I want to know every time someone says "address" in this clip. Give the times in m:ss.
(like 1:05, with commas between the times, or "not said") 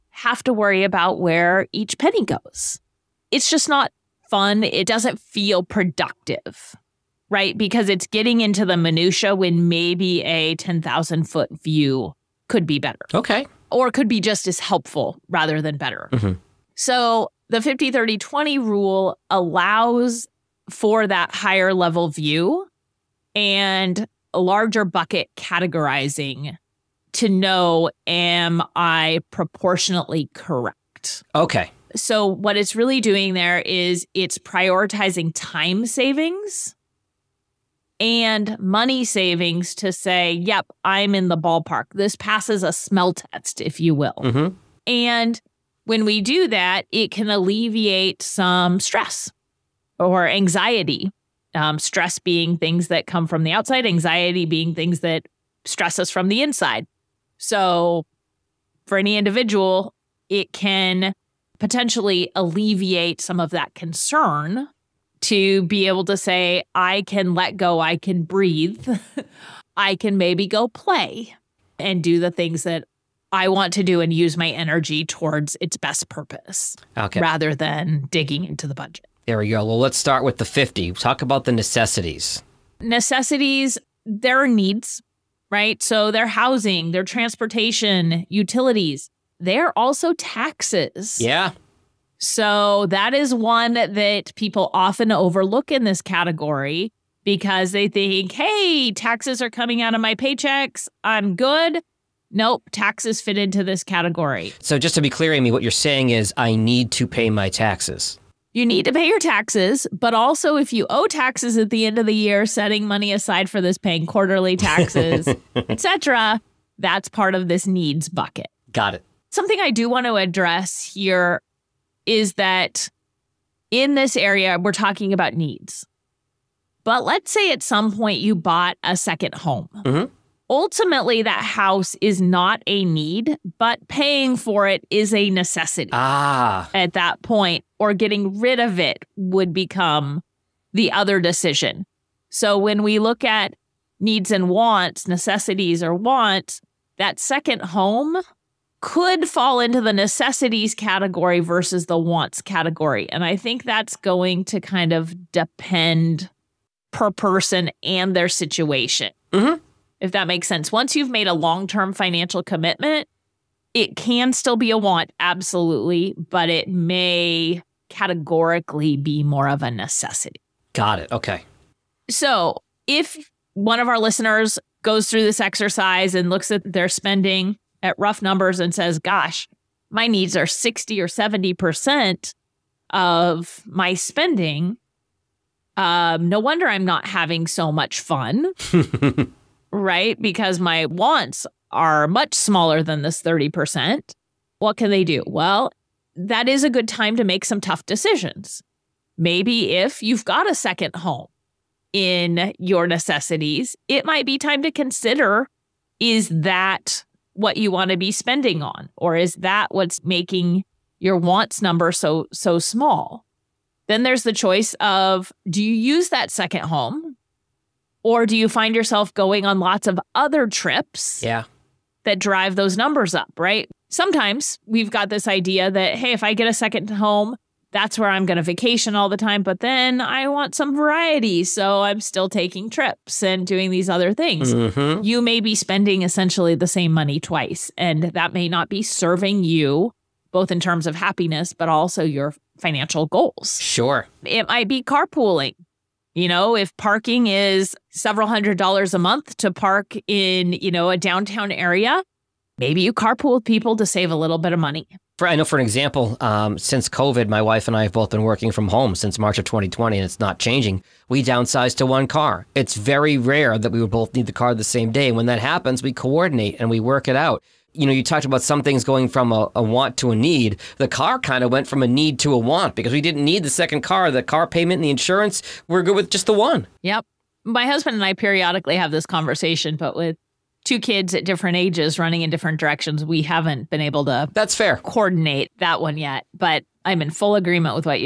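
2:00.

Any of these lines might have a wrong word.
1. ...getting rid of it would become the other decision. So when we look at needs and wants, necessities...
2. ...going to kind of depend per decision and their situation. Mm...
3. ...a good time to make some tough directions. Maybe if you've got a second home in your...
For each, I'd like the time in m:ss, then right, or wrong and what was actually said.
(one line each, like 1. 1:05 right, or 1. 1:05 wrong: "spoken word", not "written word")
1. 2:17 right
2. 2:33 wrong: "person", not "decision"
3. 3:16 wrong: "decisions", not "directions".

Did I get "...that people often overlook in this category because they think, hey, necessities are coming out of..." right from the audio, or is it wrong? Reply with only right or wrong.
wrong.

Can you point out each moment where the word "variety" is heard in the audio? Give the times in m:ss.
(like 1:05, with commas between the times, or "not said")
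3:50.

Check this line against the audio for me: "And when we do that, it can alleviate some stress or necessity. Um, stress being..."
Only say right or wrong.
wrong.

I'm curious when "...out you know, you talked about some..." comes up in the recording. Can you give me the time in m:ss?
4:27.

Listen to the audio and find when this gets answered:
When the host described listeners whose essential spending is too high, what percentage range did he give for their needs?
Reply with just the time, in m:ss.
3:00.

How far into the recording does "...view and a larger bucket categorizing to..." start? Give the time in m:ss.
0:22.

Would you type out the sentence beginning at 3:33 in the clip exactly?
Then there's the choice of do you use that second home or do you find yourself going on lots of other trips?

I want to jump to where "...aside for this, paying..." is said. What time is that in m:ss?
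1:53.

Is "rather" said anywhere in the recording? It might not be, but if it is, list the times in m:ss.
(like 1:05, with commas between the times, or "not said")
0:15, 1:17.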